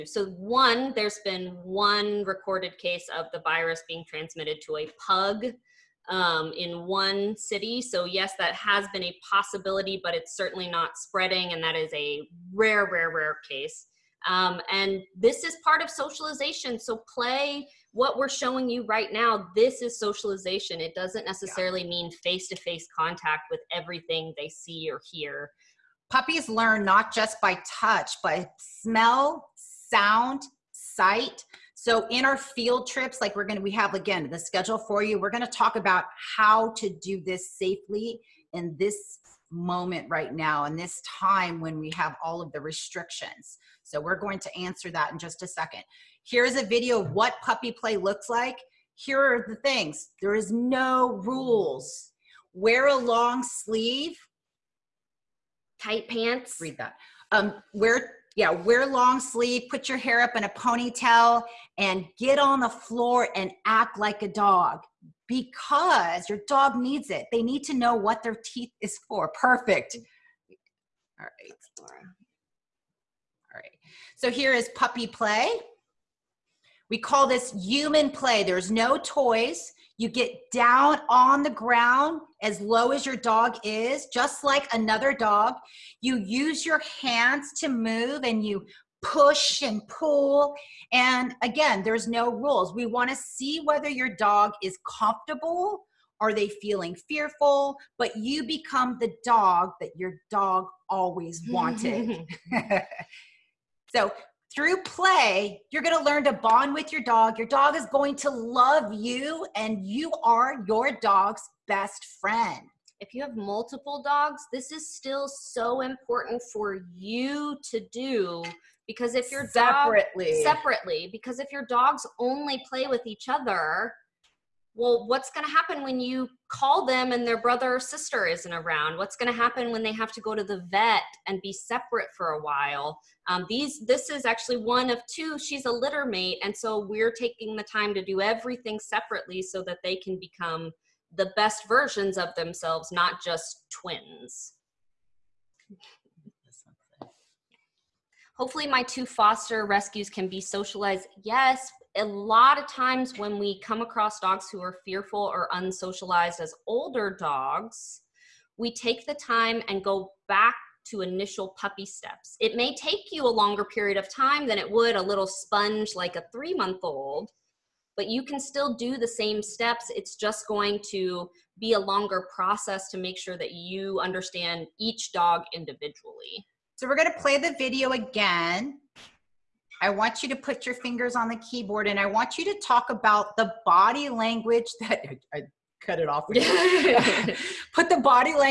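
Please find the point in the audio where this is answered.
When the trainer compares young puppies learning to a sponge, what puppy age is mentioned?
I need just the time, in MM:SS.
02:46.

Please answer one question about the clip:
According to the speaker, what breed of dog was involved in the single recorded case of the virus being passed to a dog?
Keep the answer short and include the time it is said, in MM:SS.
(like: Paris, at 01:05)
Pug, at 00:05.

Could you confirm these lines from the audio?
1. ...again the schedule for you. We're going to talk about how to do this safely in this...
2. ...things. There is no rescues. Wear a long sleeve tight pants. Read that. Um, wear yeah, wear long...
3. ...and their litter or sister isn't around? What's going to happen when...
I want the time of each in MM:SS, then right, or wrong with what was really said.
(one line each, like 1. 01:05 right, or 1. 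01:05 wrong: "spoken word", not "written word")
1. 00:33 right
2. 00:49 wrong: "rules", not "rescues"
3. 02:07 wrong: "brother", not "litter".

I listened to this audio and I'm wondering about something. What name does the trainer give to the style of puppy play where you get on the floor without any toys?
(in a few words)
Human play.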